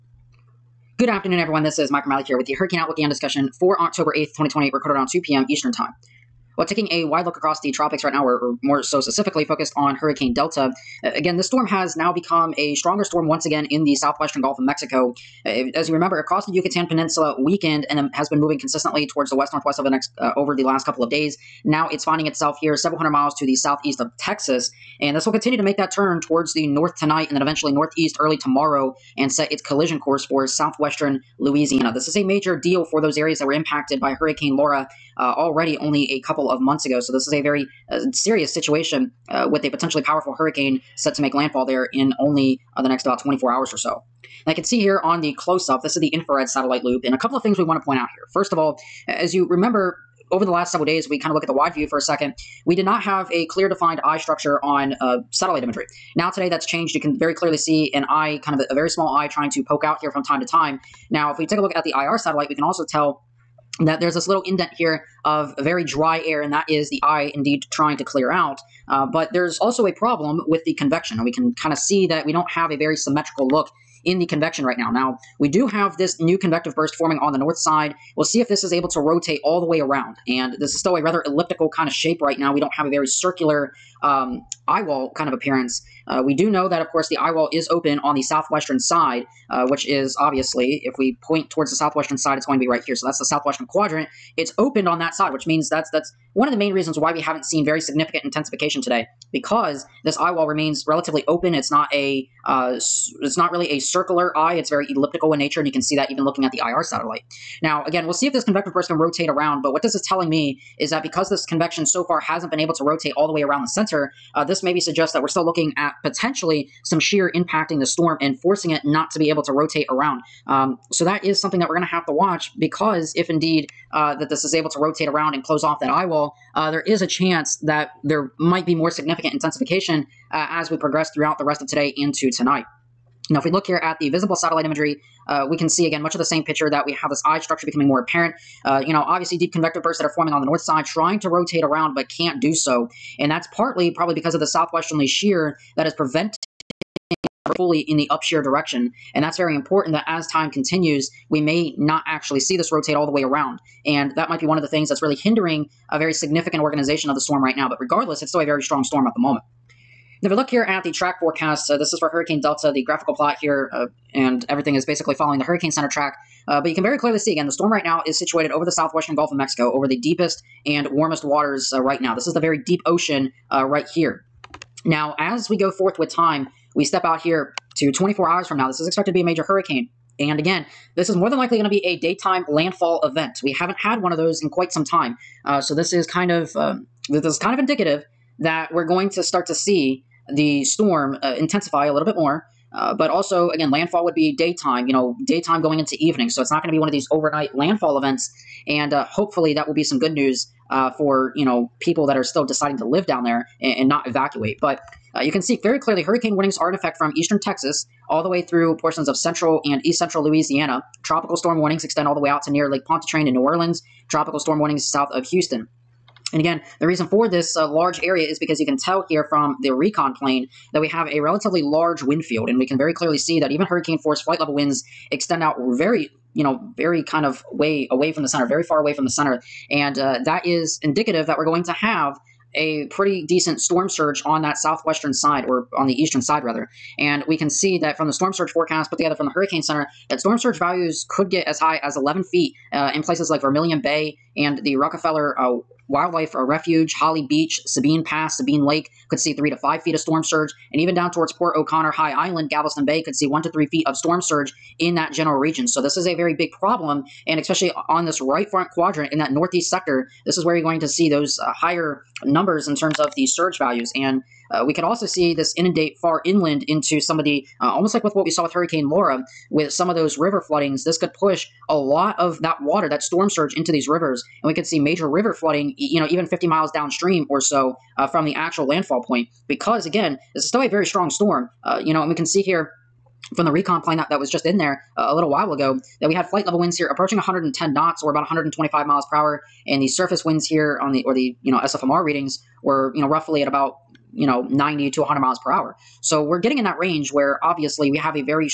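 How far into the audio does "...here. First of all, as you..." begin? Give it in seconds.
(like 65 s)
48 s.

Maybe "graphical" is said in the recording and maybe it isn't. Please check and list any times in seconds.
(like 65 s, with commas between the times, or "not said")
162 s.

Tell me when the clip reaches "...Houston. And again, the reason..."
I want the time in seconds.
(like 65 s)
215 s.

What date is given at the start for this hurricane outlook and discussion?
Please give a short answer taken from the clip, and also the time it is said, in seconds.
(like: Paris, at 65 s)
October 8th, 2020, at 3 s.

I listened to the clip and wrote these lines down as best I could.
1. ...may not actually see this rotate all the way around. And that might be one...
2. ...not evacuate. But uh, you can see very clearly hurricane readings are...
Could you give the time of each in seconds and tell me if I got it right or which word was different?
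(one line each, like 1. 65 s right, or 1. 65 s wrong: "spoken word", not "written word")
1. 151 s right
2. 203 s wrong: "warnings", not "readings".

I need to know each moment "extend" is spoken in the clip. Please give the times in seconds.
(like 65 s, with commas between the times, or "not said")
211 s, 225 s.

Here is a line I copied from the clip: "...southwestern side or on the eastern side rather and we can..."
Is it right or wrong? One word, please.
right.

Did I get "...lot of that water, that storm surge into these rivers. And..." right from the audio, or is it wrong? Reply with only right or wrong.
right.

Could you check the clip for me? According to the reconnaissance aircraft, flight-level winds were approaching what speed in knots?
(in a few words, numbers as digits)
110 knots.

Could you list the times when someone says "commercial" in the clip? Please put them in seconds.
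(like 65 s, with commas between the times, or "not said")
not said.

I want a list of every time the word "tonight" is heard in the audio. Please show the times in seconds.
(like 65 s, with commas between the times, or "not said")
26 s, 132 s.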